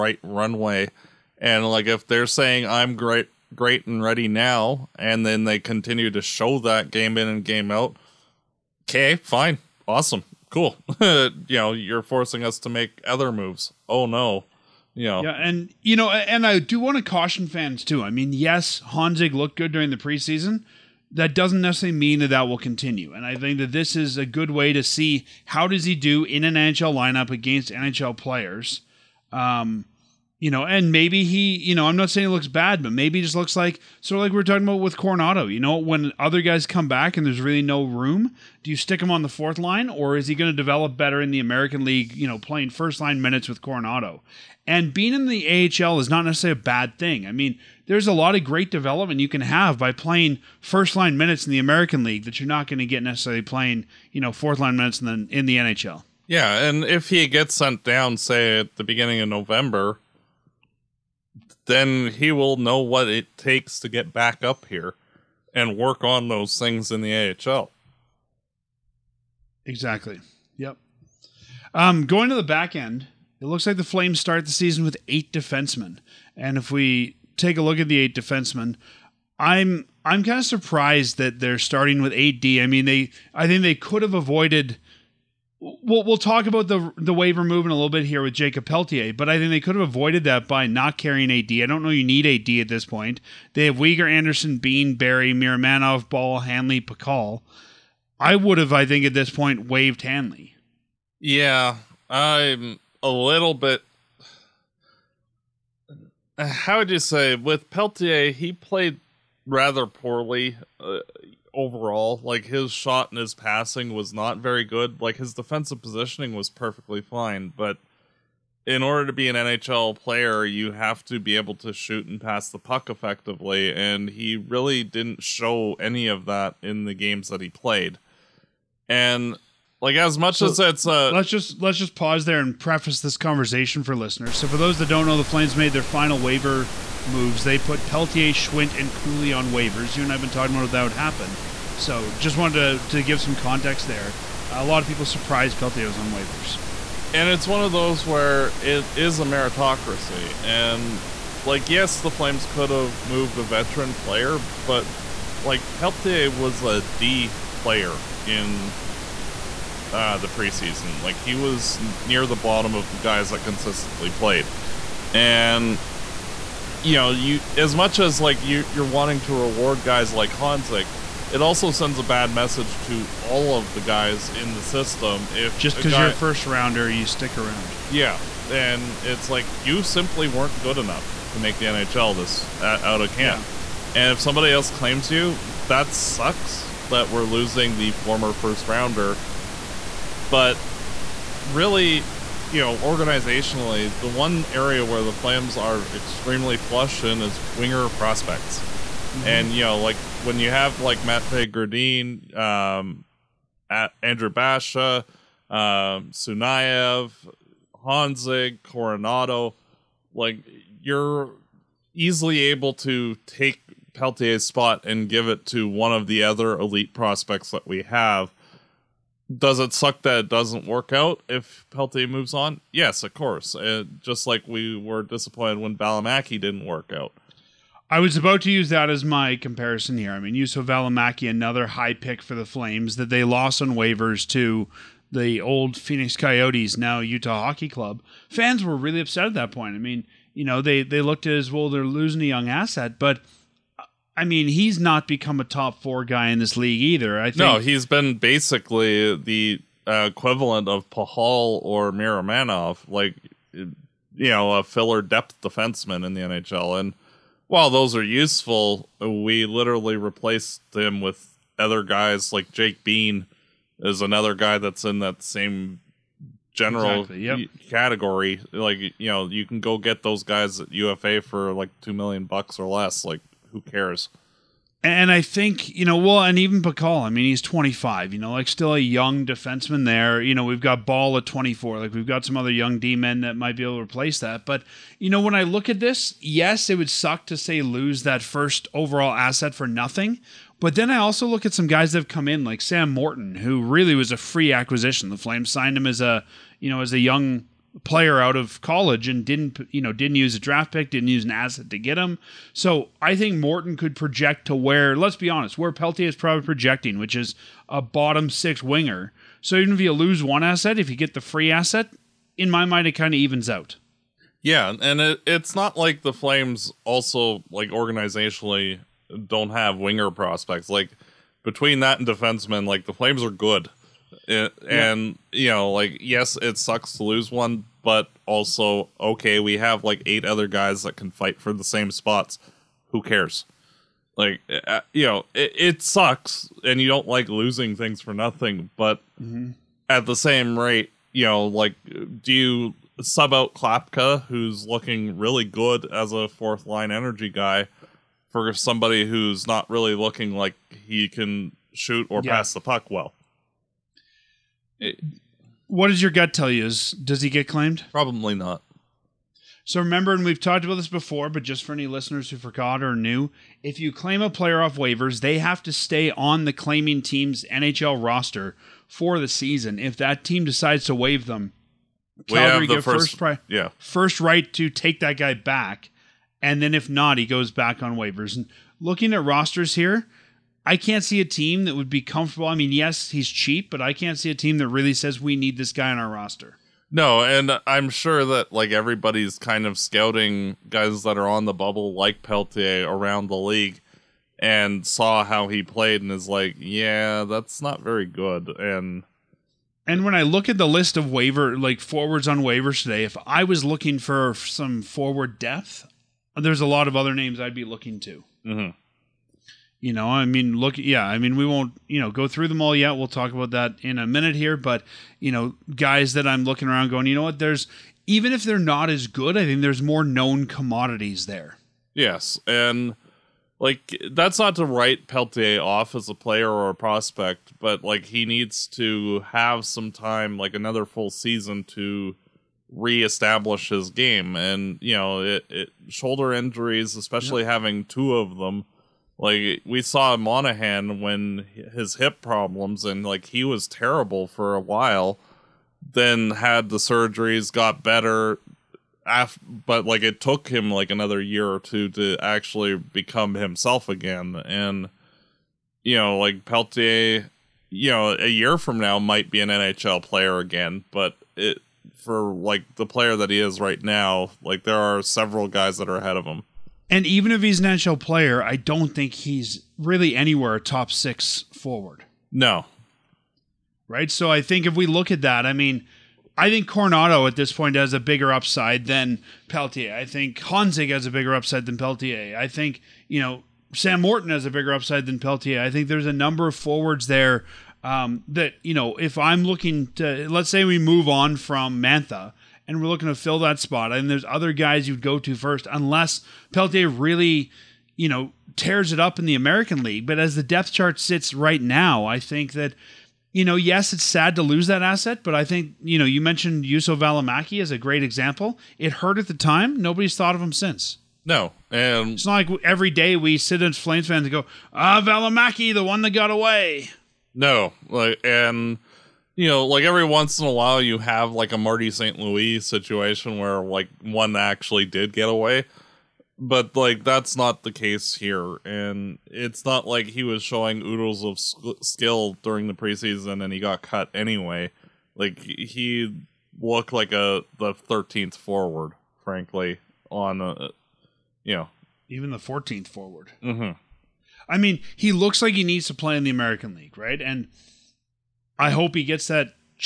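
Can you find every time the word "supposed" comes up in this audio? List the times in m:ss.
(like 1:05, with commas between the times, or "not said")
not said.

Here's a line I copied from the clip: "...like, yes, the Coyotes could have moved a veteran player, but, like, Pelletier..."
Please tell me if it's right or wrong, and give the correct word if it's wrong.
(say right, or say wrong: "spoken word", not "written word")
wrong: "Flames", not "Coyotes".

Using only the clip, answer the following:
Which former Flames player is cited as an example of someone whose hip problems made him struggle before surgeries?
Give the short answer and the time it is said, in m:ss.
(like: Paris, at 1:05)
Monahan, at 7:20.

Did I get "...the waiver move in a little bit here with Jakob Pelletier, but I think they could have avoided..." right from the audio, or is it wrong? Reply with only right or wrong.
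right.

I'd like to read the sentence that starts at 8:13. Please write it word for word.
And there's other guys you'd go to first, unless Pelletier really, you know, tears it up in the American League.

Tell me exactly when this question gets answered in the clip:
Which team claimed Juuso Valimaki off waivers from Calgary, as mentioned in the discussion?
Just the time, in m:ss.
3:55.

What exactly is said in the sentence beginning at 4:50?
But then I also look at some guys that have come in, like Sam Morton, who really was a free acquisition.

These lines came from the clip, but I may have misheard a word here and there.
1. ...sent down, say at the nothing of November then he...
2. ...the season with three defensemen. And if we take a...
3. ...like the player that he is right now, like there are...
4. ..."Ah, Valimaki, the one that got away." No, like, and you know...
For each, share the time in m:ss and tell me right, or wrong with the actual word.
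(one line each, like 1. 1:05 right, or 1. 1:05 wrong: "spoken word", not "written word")
1. 0:57 wrong: "beginning", not "nothing"
2. 1:14 wrong: "eight", not "three"
3. 7:42 right
4. 8:34 right.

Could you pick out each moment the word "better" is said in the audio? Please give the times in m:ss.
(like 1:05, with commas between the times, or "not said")
0:40, 7:27.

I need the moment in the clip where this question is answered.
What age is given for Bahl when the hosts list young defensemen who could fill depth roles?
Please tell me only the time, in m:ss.
4:41.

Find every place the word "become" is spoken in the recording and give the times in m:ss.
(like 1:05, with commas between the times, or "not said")
4:05, 7:32.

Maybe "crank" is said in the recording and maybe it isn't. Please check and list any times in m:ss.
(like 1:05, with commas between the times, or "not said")
not said.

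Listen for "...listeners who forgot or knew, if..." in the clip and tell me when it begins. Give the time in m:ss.
6:01.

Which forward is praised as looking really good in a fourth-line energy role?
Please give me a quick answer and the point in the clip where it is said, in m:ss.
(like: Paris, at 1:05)
Klapka, at 5:43.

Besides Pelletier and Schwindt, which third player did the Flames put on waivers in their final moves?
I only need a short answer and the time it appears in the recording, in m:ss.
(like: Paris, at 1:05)
Cooley, at 2:18.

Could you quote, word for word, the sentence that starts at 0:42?
You know, playing first line minutes with Coronato, and being in the AHL is not necessarily a bad thing.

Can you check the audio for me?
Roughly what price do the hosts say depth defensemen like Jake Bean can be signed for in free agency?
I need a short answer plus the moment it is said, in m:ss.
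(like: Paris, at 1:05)
2 million, at 4:31.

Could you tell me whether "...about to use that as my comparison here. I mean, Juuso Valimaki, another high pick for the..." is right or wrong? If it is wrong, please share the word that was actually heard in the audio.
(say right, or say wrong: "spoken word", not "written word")
right.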